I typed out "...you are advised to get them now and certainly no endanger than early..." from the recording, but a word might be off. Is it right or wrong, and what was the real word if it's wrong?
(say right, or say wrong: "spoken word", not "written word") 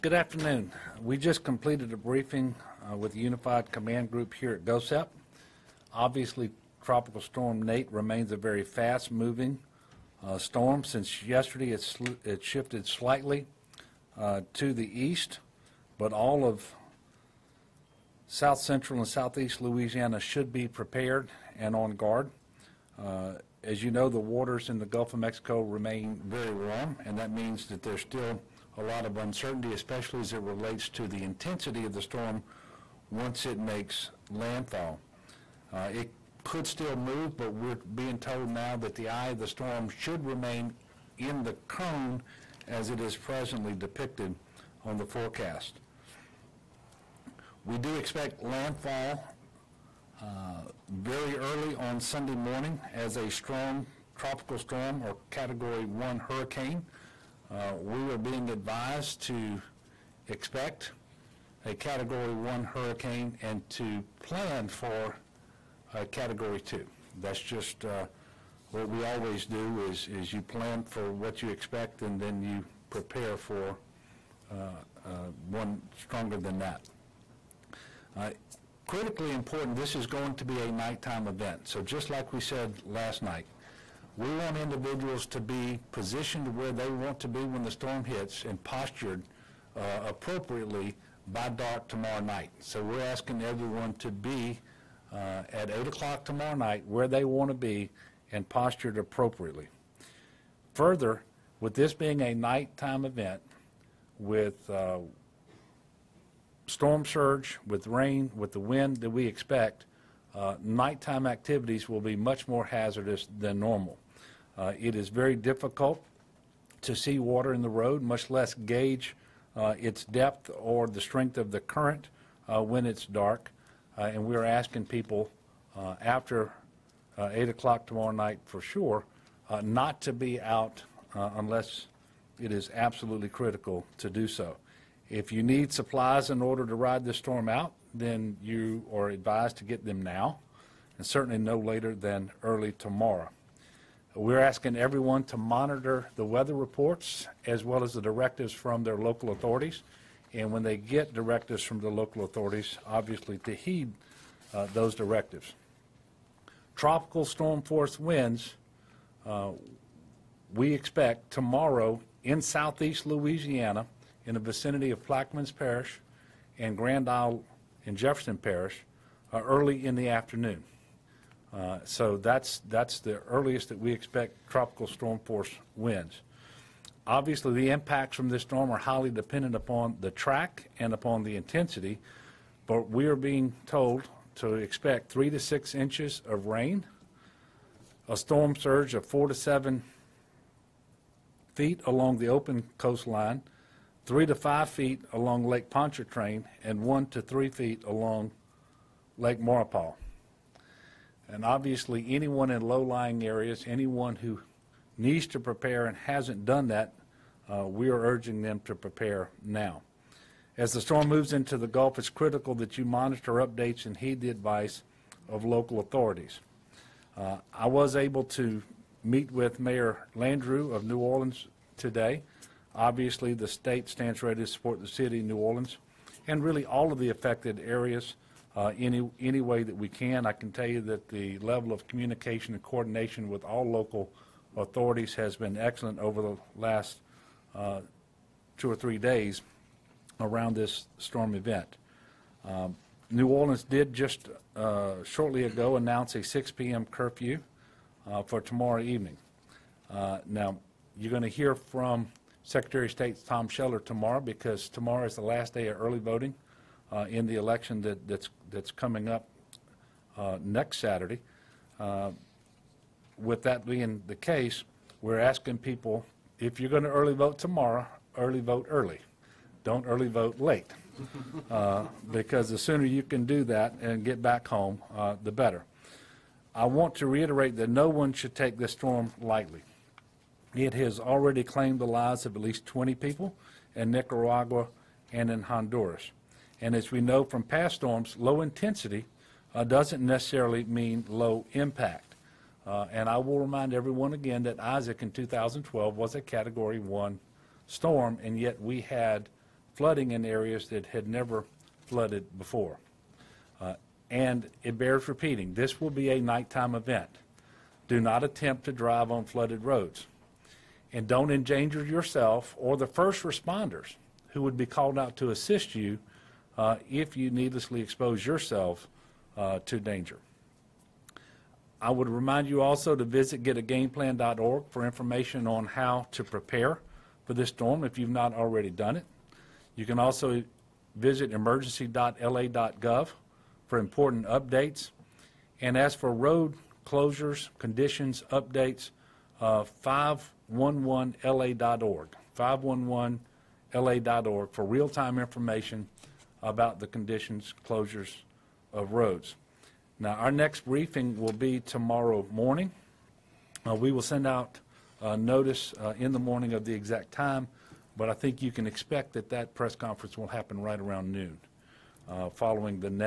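wrong: "later", not "endanger".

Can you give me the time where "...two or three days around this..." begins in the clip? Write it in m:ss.
3:58.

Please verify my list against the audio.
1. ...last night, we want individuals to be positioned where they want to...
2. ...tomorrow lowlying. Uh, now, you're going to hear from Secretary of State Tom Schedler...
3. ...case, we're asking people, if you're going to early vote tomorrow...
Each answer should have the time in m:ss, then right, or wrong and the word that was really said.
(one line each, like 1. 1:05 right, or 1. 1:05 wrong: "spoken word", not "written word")
1. 1:22 right
2. 4:08 wrong: "evening", not "lowlying"
3. 4:24 right.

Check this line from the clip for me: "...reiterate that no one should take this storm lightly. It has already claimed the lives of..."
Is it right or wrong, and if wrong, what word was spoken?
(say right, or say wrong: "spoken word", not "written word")
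right.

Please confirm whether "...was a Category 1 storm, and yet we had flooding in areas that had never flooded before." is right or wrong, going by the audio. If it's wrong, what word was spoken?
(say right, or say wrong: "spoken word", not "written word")
right.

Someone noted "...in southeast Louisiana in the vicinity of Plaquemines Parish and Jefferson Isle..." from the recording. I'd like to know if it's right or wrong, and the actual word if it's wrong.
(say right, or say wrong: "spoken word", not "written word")
wrong: "Grand", not "Jefferson".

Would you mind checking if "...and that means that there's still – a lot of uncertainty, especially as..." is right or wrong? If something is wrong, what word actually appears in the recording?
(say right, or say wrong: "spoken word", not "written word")
right.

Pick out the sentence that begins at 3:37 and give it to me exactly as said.
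Uh, I was able to meet with Mayor Landrieu of New Orleans today.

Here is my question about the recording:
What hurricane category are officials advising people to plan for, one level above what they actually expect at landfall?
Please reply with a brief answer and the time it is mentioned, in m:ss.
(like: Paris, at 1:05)
Category 2, at 1:06.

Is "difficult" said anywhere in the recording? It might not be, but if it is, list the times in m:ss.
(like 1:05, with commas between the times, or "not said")
1:55.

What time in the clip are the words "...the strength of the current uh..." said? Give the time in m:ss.
2:00.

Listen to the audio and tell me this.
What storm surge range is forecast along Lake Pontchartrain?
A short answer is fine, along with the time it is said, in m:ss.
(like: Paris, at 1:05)
3 to 5 feet, at 3:14.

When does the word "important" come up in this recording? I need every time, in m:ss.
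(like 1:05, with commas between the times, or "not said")
1:19, 5:33.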